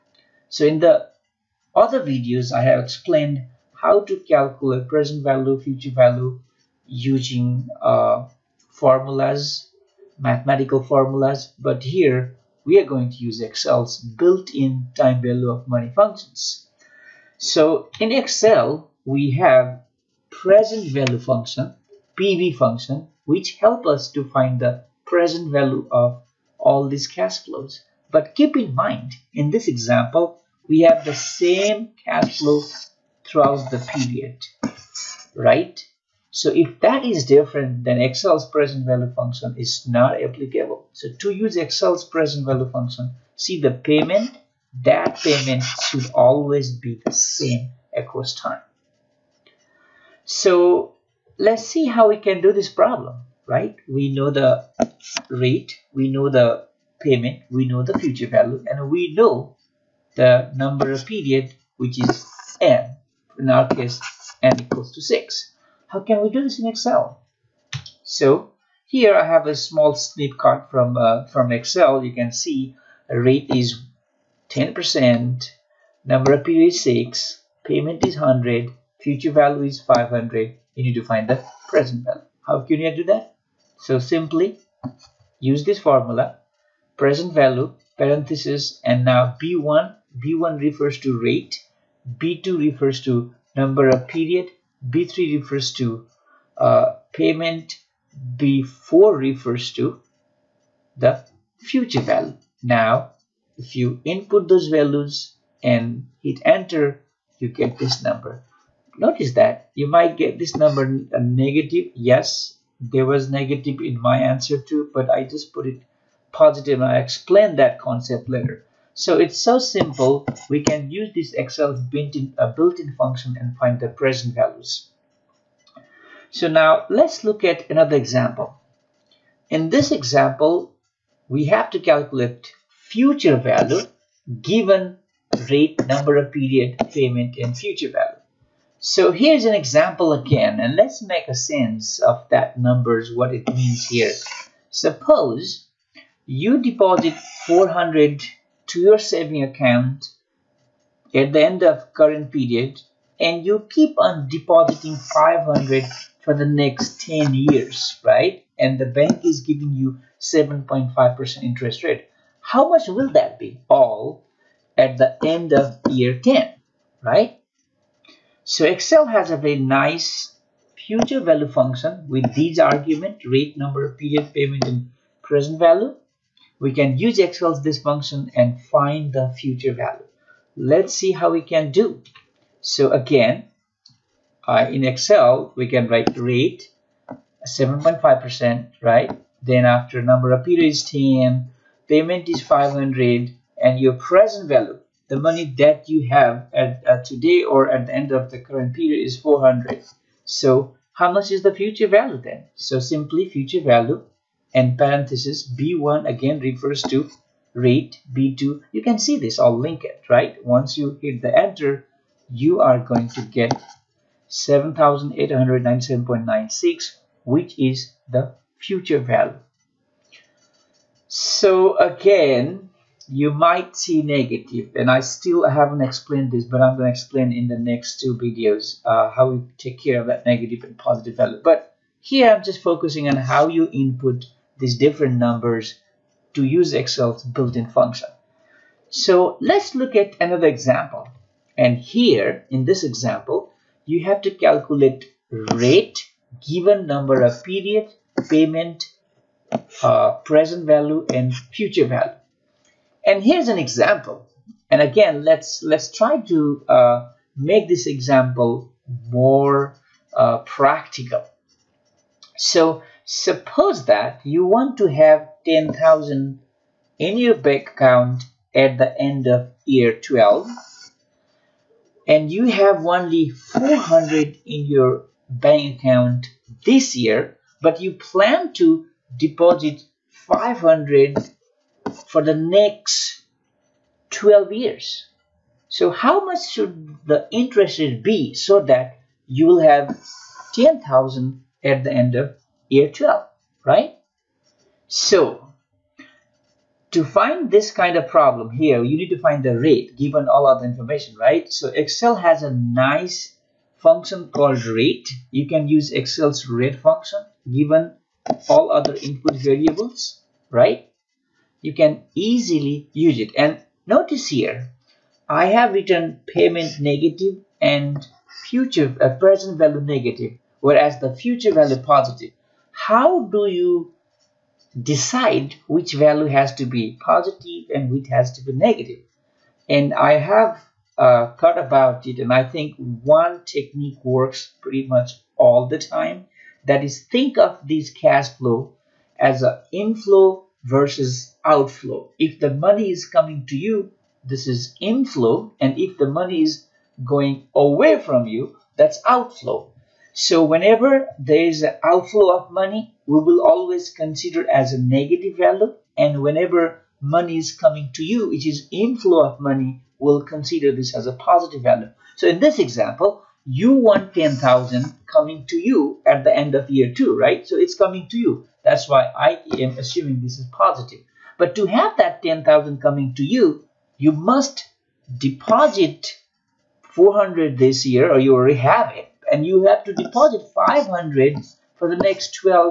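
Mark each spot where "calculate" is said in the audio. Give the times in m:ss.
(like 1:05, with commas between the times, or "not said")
0:04, 2:11, 4:04.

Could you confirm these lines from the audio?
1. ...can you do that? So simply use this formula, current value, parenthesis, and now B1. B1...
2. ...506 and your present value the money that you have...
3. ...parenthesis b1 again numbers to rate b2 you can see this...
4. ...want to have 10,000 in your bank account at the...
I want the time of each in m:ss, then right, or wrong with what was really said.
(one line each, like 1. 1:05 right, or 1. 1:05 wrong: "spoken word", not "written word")
1. 1:22 wrong: "present", not "current"
2. 3:12 wrong: "500", not "506"
3. 3:24 wrong: "refers", not "numbers"
4. 4:24 right.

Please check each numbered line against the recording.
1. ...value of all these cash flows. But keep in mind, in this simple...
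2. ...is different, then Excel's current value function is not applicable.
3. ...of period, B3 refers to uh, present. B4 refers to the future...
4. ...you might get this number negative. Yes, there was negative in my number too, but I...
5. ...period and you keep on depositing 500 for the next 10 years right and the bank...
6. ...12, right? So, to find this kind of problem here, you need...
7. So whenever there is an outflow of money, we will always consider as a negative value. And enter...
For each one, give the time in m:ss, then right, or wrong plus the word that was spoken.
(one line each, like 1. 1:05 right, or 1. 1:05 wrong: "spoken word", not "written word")
1. 0:25 wrong: "example", not "simple"
2. 0:37 wrong: "present", not "current"
3. 1:33 wrong: "payment", not "present"
4. 1:49 wrong: "answer", not "number"
5. 2:32 right
6. 4:52 right
7. 5:50 wrong: "whenever", not "enter".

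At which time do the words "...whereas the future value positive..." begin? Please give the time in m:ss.
5:20.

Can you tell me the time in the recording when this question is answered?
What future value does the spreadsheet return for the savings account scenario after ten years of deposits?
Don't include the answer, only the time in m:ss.
3:34.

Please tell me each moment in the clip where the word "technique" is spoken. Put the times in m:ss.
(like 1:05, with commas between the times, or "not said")
5:33.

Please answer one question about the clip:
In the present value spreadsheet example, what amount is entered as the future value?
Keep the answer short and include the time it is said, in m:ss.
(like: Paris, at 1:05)
500, at 1:19.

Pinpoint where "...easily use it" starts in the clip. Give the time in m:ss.
5:12.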